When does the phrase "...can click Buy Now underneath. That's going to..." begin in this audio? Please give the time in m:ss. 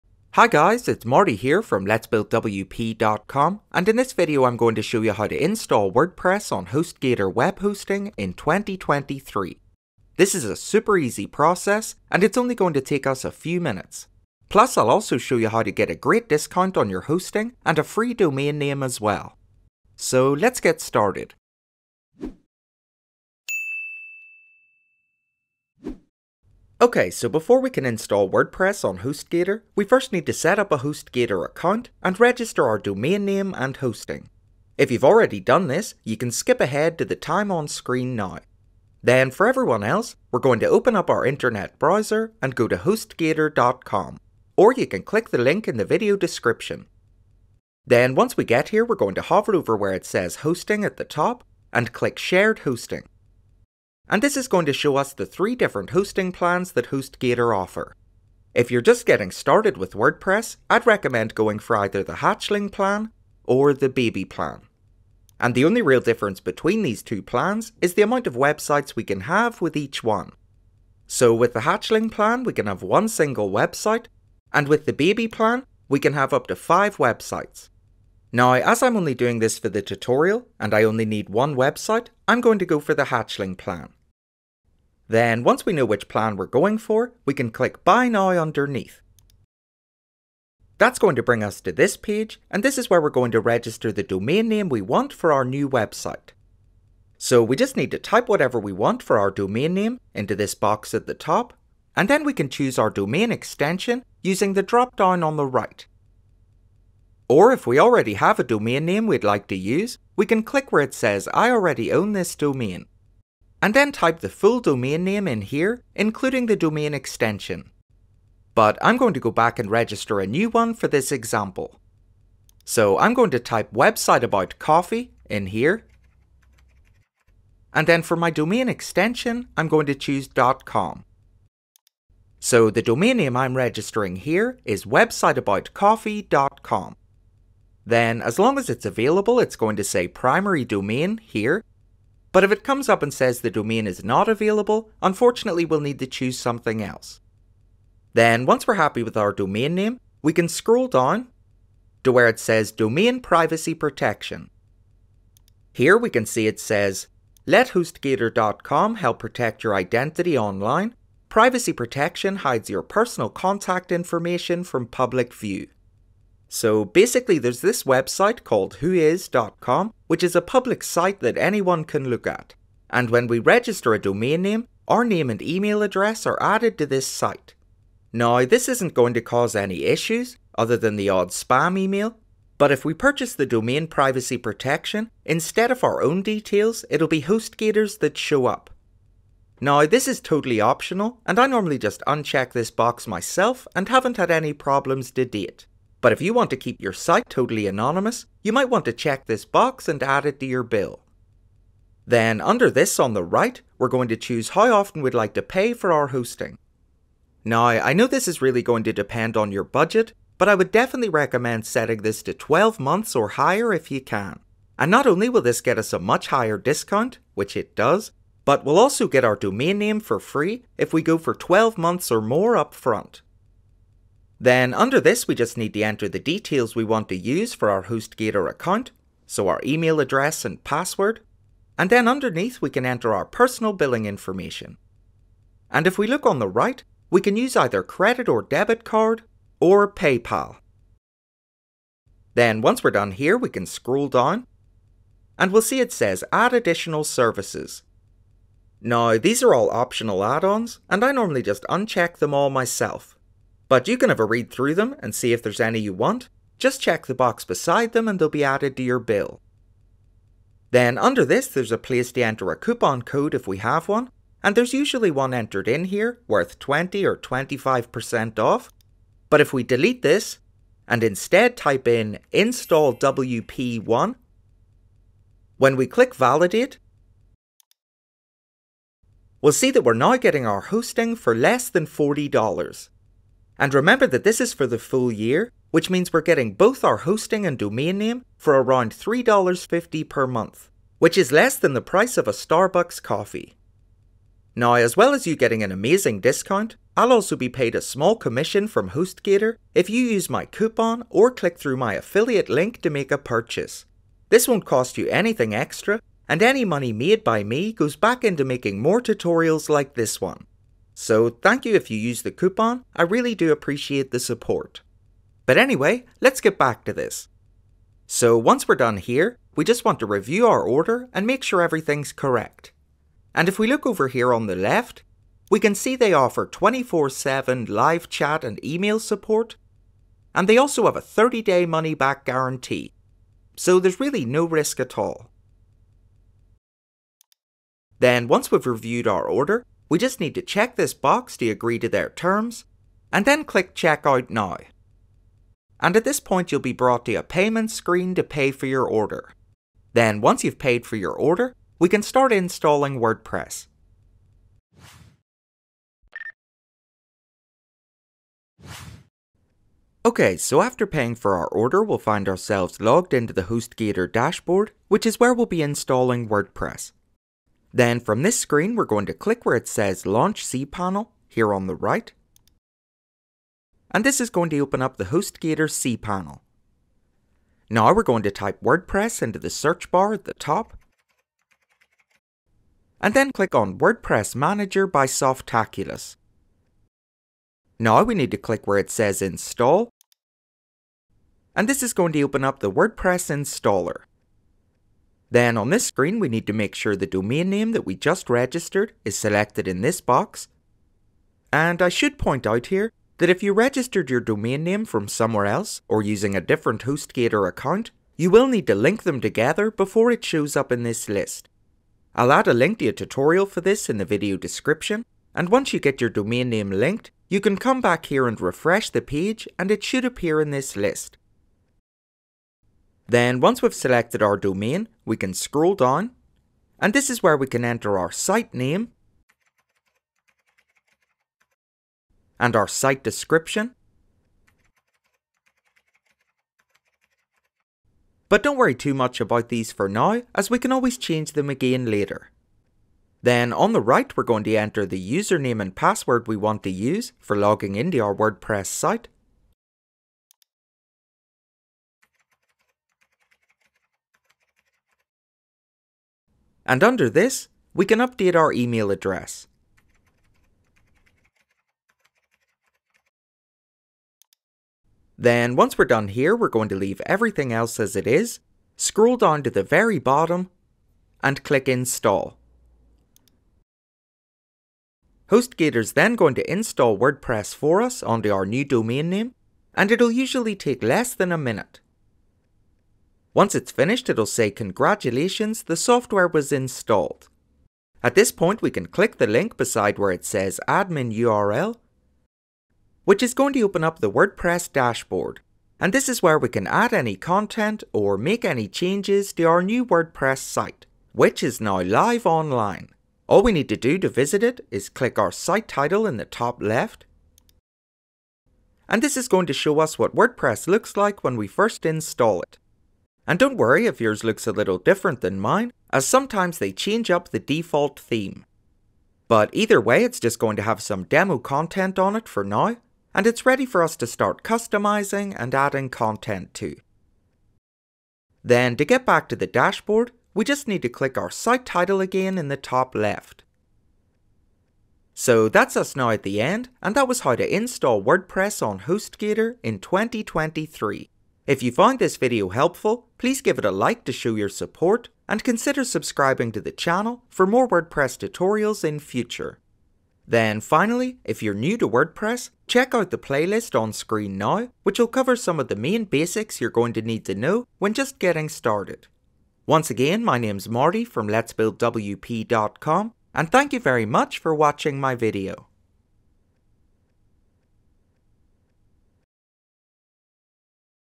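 1:27.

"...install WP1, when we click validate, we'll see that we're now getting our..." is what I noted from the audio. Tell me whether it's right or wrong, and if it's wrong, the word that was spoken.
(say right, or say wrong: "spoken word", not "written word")
right.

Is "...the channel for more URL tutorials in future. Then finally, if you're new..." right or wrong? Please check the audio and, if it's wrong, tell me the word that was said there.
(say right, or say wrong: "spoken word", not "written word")
wrong: "WordPress", not "URL".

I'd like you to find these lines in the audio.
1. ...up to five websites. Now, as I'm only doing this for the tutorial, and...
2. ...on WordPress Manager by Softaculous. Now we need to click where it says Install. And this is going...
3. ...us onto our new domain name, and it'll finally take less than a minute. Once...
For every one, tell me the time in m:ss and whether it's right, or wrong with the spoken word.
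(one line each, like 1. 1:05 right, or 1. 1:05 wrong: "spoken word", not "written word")
1. 1:16 right
2. 6:23 right
3. 7:57 wrong: "usually", not "finally".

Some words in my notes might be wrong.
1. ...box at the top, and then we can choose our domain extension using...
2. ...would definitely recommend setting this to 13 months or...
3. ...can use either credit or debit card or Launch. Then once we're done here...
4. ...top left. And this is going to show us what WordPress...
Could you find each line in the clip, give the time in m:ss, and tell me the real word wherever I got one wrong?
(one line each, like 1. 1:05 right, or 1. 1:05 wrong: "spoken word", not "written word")
1. 1:40 right
2. 3:30 wrong: "12", not "13"
3. 3:57 wrong: "PayPal", not "Launch"
4. 8:26 right.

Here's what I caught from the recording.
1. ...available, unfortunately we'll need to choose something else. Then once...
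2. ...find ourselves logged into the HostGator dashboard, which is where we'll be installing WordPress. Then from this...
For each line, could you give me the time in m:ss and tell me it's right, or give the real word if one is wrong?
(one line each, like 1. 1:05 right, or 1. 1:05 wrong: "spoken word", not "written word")
1. 2:24 right
2. 6:01 right.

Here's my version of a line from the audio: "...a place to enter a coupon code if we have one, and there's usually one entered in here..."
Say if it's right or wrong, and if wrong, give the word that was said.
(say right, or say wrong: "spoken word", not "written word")
right.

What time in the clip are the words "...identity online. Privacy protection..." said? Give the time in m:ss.
2:39.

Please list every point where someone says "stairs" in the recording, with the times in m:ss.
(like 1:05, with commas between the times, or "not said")
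not said.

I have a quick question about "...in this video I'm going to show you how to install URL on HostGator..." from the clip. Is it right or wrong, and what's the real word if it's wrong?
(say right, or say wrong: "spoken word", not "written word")
wrong: "WordPress", not "URL".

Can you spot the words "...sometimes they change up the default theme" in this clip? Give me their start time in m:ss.
8:36.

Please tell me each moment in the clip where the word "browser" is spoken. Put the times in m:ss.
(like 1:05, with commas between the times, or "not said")
0:41.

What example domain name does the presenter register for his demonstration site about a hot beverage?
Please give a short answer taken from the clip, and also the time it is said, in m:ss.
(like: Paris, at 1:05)
websiteaboutcoffee.com, at 2:14.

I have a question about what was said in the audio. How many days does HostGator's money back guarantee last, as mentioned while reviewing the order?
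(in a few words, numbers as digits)
30.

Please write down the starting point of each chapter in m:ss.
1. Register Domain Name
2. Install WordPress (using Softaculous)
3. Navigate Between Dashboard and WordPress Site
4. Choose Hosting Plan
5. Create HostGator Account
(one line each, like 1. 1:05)
1. 1:30
2. 5:58
3. 8:12
4. 0:40
5. 2:27.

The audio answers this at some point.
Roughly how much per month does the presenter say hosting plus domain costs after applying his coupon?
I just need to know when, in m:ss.
4:48.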